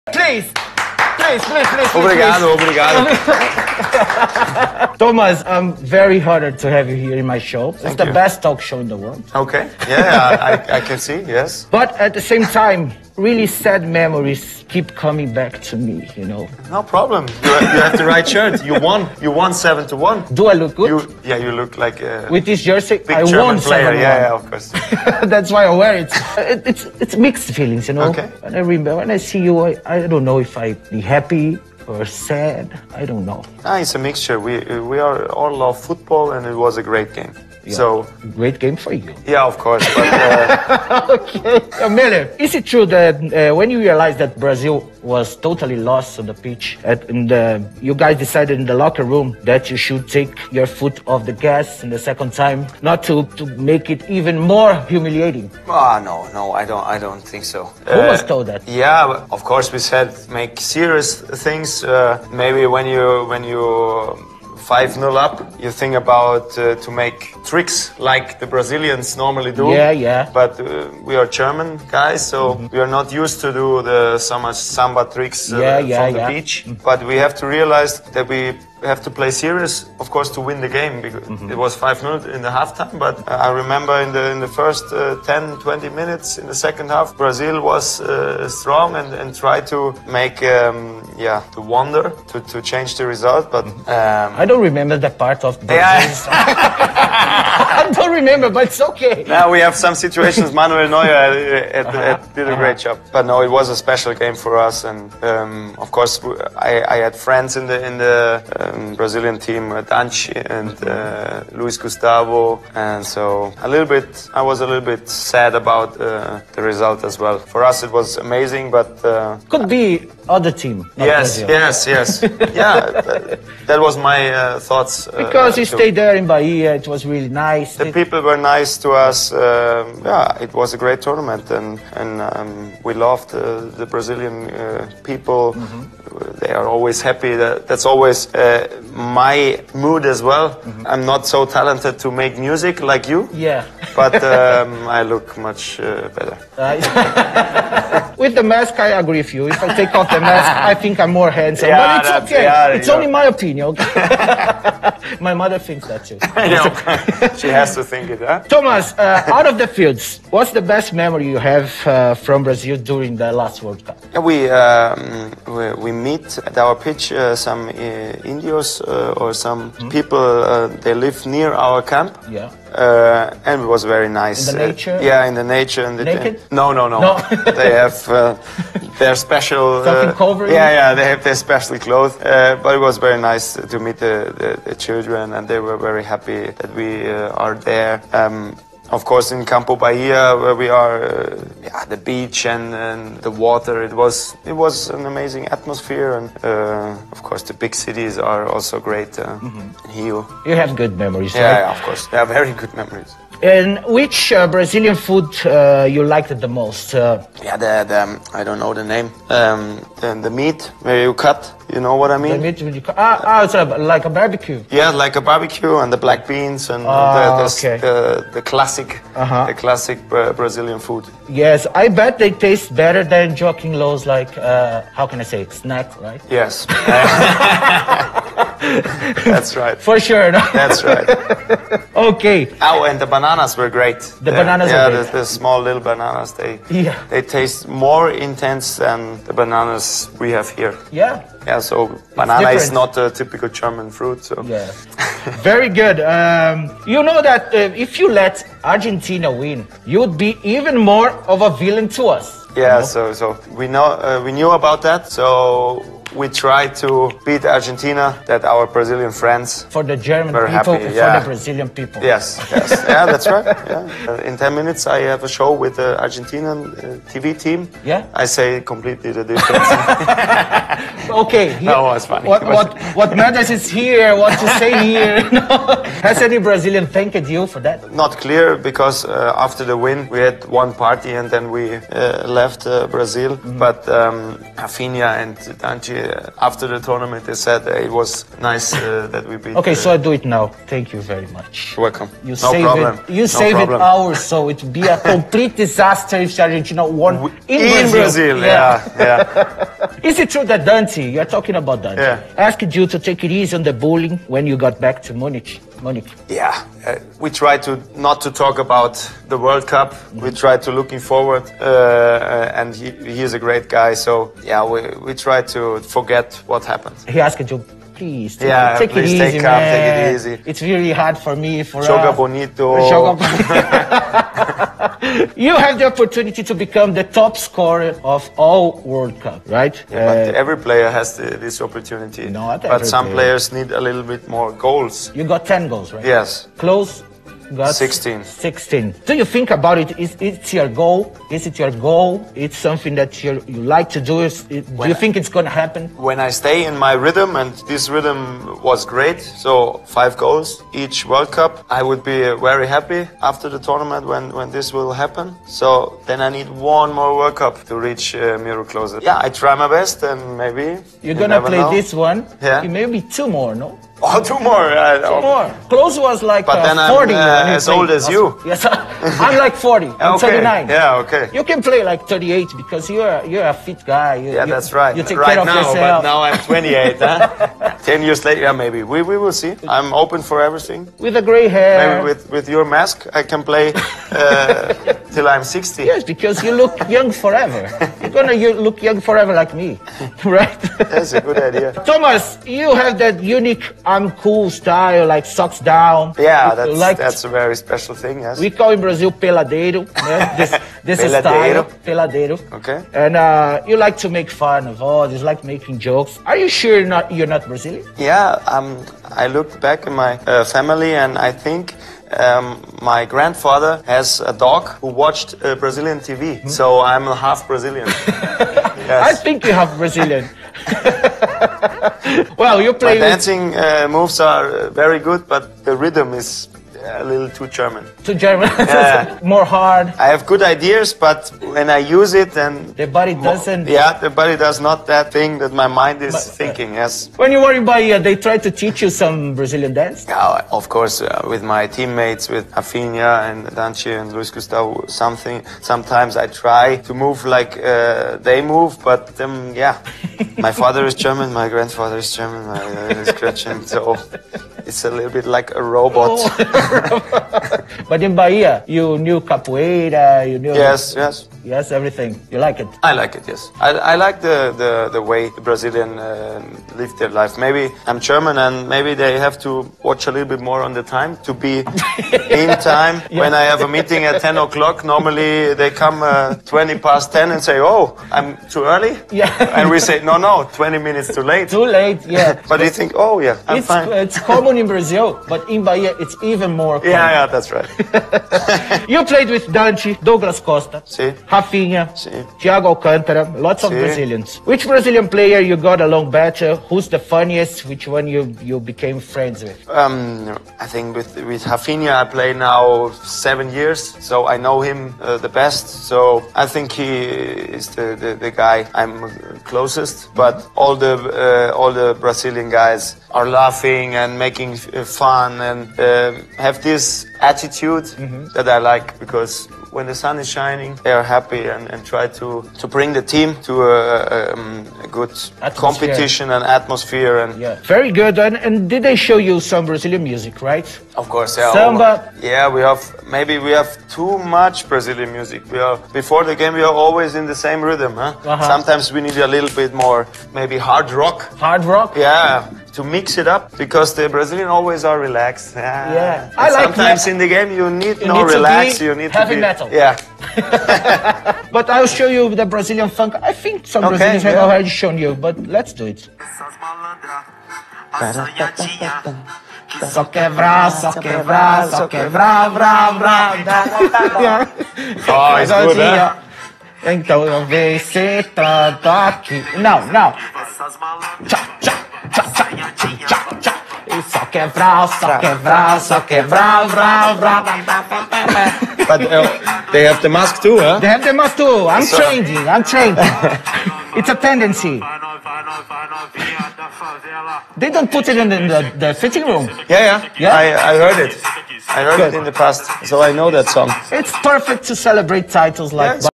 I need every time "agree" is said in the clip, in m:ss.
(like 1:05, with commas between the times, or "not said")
2:29.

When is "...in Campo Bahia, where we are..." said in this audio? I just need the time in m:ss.
3:09.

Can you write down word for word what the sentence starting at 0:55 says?
Ah, oh, no, no, I don't, I don't think so.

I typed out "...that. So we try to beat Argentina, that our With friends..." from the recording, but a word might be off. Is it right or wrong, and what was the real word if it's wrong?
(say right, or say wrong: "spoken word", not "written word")
wrong: "Brazilian", not "With".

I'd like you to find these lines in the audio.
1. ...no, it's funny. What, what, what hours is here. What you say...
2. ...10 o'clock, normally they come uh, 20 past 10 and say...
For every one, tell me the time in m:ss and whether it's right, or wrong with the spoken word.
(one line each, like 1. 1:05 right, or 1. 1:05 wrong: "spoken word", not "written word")
1. 4:31 wrong: "matters", not "hours"
2. 7:54 right.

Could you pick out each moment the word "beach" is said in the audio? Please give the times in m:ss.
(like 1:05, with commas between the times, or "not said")
1:16, 3:11.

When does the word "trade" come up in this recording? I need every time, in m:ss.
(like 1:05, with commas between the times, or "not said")
not said.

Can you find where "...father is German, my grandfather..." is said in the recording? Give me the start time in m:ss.
7:30.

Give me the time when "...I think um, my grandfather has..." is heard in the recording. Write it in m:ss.
6:51.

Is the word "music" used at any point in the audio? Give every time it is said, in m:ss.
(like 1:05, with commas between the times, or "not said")
2:22, 8:50, 8:55.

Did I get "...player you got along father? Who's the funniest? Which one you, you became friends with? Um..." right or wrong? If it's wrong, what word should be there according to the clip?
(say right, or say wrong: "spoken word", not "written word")
wrong: "better", not "father".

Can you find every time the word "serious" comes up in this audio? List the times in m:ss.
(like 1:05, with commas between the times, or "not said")
1:00, 1:19.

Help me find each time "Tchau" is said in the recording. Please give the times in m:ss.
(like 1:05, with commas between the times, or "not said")
9:31.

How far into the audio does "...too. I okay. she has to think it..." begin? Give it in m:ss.
2:36.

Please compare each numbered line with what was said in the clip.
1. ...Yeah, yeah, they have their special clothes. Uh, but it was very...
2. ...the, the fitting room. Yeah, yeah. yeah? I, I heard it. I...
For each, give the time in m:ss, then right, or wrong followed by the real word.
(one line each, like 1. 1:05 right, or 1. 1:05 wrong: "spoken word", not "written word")
1. 3:00 right
2. 9:48 right.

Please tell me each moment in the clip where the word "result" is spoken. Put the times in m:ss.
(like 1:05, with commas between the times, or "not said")
1:33, 1:56.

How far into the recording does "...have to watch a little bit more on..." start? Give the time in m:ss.
7:49.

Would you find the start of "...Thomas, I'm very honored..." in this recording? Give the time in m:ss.
0:04.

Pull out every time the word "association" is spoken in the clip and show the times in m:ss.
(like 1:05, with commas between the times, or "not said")
not said.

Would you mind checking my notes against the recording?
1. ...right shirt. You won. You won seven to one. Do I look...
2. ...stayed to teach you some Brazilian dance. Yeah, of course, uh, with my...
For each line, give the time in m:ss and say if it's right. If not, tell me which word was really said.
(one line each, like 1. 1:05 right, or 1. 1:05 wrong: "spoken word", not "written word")
1. 0:18 right
2. 7:18 wrong: "tried", not "stayed".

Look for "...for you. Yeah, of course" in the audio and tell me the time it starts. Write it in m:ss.
0:38.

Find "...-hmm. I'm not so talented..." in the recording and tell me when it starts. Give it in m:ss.
2:20.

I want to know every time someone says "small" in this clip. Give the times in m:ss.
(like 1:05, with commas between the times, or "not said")
3:55.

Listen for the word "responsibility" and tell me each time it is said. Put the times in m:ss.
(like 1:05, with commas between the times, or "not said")
not said.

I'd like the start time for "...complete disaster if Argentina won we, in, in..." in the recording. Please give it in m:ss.
4:54.